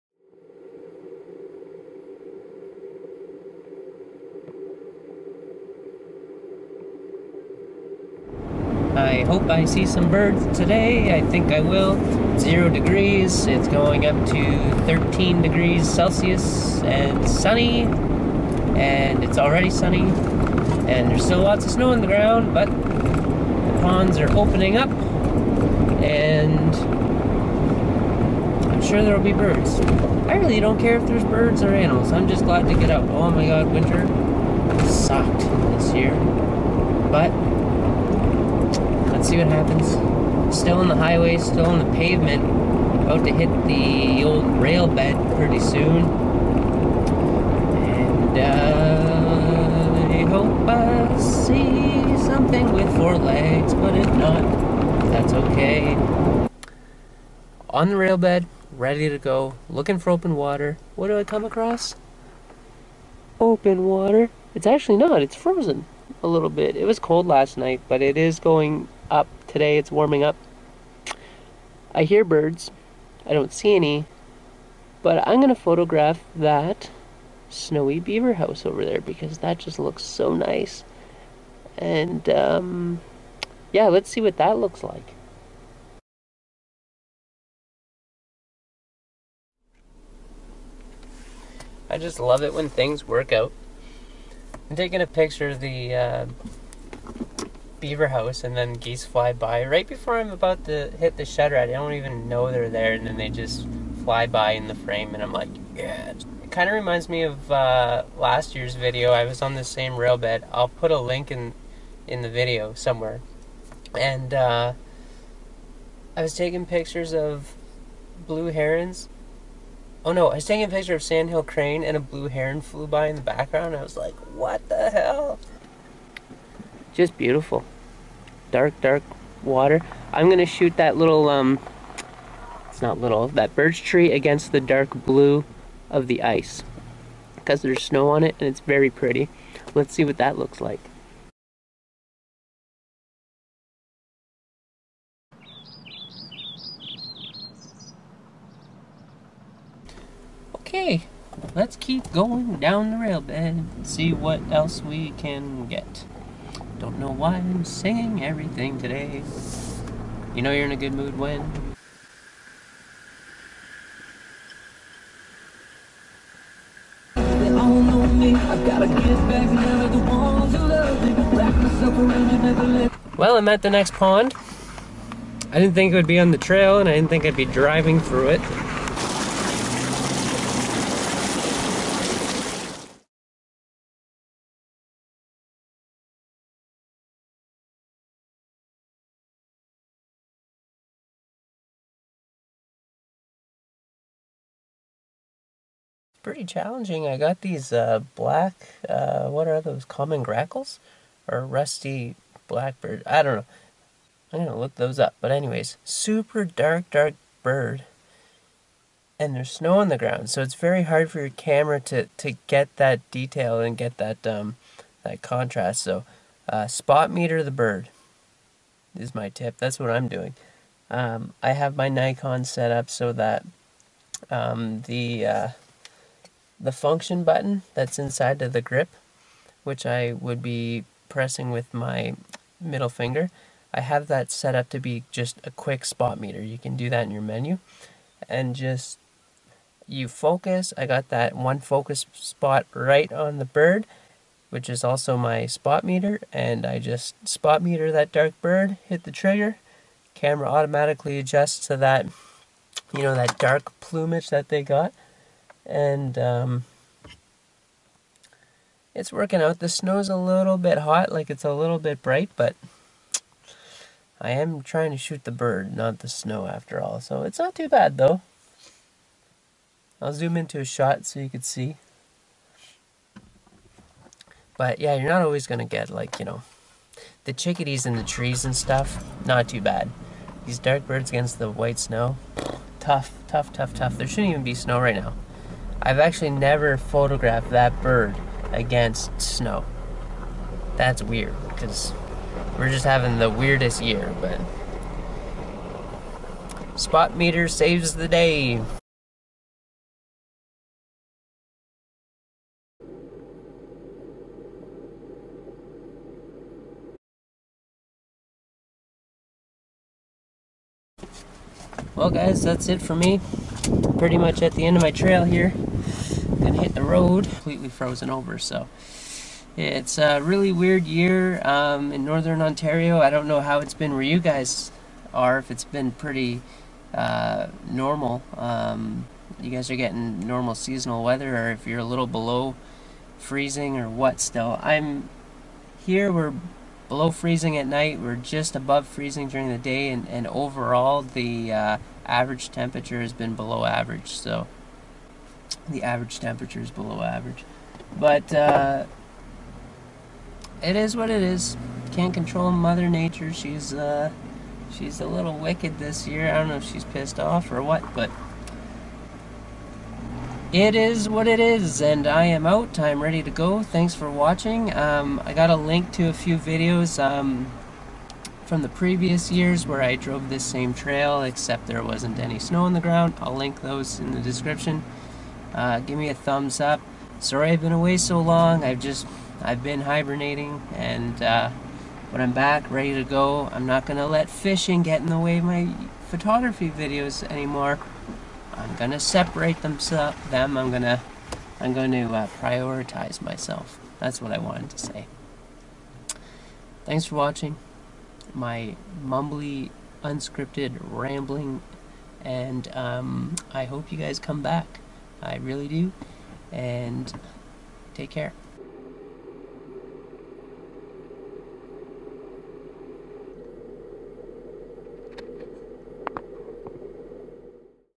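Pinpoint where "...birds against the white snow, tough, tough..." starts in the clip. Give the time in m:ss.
4:40.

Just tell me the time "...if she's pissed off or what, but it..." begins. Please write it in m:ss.
5:56.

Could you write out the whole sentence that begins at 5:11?
Well guys, that's it for me.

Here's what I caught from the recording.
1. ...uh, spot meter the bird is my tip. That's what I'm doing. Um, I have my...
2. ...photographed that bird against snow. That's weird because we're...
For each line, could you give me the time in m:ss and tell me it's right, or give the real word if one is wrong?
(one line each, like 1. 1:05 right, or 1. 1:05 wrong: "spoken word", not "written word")
1. 3:36 right
2. 4:46 right.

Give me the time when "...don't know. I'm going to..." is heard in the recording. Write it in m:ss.
3:23.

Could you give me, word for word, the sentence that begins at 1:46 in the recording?
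It kind of reminds me of uh, last year's video.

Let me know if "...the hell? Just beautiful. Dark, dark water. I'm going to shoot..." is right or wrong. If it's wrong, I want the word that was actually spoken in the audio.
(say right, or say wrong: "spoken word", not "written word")
right.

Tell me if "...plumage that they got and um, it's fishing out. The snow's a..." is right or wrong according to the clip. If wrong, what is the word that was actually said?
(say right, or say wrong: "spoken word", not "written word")
wrong: "working", not "fishing".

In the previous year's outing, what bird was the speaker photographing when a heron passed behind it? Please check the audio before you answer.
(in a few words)
Sandhill Crane.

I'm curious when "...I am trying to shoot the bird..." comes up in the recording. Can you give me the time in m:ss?
4:24.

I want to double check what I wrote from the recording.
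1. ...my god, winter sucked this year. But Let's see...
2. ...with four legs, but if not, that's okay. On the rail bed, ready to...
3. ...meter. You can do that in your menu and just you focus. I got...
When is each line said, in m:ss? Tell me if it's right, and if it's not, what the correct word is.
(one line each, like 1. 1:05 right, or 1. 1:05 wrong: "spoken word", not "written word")
1. 0:33 right
2. 0:52 right
3. 3:56 right.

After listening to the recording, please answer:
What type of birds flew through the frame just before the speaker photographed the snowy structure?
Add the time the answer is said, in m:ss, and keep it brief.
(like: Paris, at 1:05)
geese, at 1:38.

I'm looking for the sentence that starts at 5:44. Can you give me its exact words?
So the average temperature is below average.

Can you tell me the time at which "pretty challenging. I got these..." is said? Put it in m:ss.
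3:16.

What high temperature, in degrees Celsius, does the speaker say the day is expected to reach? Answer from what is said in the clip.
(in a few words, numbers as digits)
13.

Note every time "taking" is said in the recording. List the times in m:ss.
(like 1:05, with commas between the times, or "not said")
1:34, 1:56, 2:00.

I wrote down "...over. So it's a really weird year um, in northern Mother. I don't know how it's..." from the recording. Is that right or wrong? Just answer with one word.
wrong.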